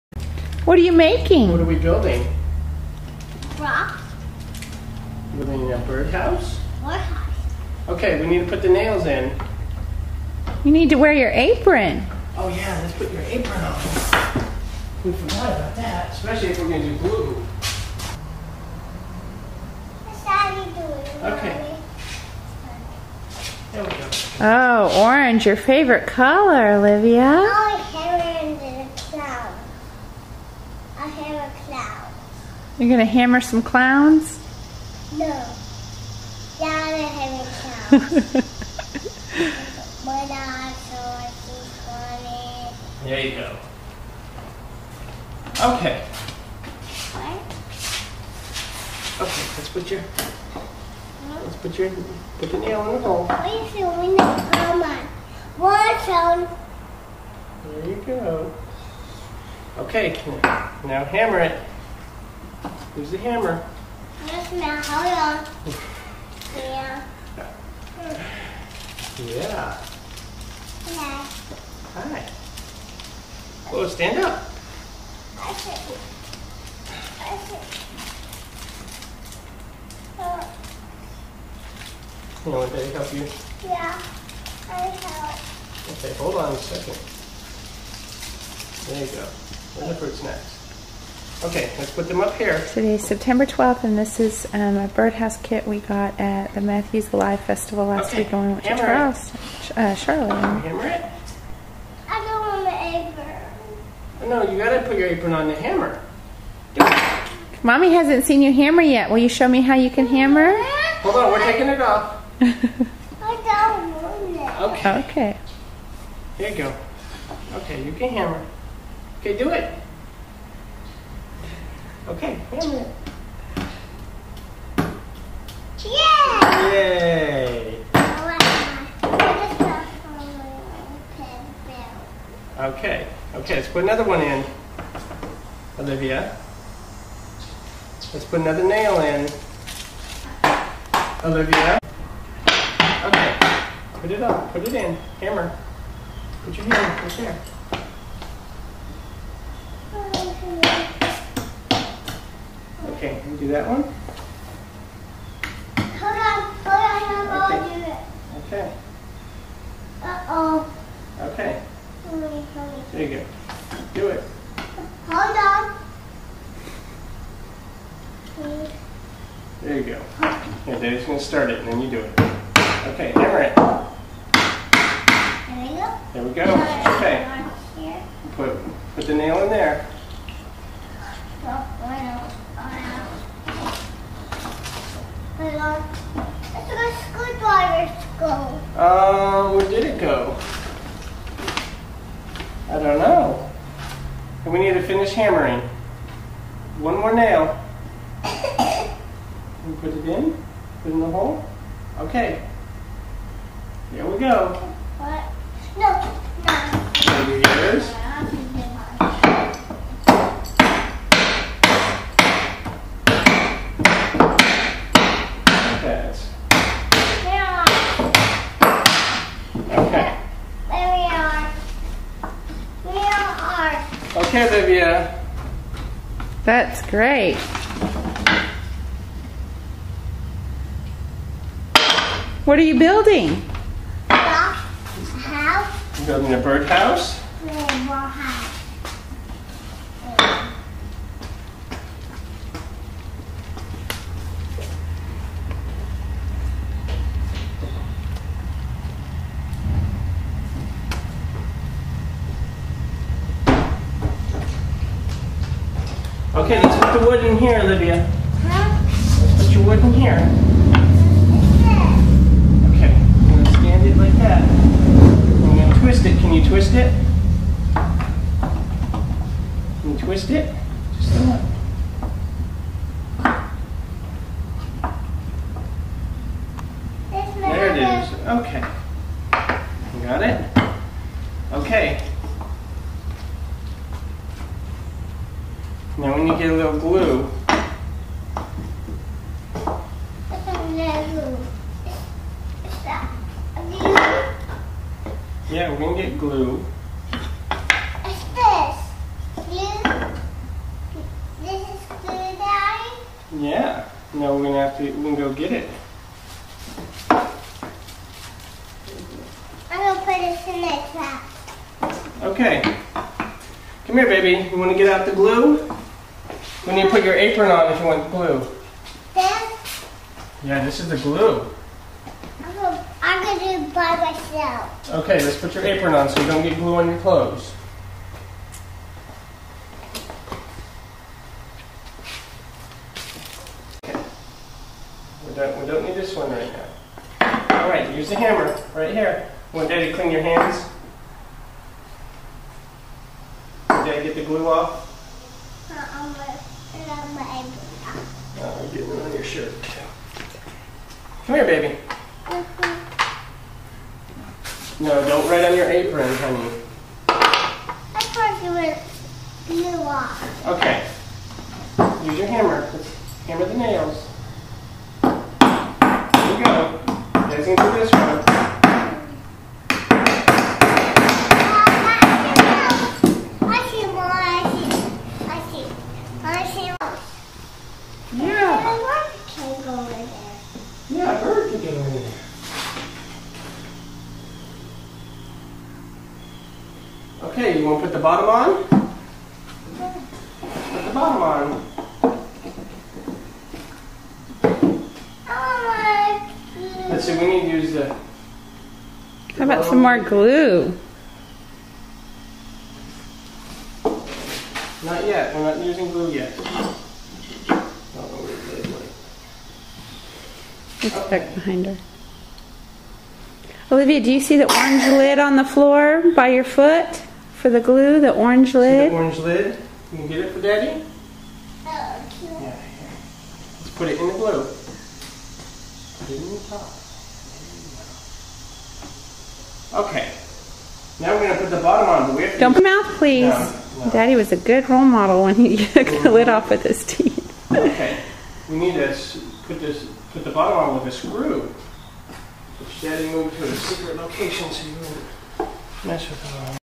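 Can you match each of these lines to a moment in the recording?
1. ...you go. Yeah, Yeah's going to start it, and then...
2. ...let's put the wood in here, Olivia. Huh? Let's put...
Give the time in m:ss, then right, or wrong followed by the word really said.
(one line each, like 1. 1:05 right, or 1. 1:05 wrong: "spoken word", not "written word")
1. 2:49 wrong: "Daddy", not "Yeah"
2. 4:16 right.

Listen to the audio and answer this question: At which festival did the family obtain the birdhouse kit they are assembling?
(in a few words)
Matthews Alive Festival.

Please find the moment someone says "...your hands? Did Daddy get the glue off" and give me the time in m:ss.
5:40.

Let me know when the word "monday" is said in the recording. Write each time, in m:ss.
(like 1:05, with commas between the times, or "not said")
not said.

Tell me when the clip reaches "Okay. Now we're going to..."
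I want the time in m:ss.
7:09.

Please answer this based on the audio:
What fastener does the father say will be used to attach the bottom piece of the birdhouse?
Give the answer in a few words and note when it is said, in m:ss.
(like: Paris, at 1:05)
A screw, at 7:20.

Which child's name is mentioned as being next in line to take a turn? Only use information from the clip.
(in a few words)
Jennifer.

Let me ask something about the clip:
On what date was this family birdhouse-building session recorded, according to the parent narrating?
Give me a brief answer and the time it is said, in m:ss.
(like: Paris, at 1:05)
September 12th, at 1:33.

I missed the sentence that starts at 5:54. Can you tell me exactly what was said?
No, don't write on your apron, honey.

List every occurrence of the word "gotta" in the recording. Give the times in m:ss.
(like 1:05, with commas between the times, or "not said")
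1:44.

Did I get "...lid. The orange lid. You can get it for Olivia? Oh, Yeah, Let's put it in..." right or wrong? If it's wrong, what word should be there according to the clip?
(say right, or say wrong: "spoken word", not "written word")
wrong: "Daddy", not "Olivia".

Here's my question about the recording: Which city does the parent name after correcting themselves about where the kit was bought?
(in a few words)
Charlotte.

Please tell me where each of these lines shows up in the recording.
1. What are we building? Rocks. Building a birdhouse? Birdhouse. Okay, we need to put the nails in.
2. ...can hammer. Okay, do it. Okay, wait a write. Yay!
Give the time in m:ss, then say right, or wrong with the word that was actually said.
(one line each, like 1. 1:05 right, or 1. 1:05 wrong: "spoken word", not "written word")
1. 0:01 right
2. 1:57 wrong: "minute", not "write".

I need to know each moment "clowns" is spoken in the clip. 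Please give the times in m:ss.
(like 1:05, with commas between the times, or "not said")
0:33, 0:37.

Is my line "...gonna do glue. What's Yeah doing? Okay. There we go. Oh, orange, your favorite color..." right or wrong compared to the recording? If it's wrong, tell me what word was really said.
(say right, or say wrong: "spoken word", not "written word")
wrong: "Daddy", not "Yeah".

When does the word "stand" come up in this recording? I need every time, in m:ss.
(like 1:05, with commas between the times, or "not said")
1:13, 4:23.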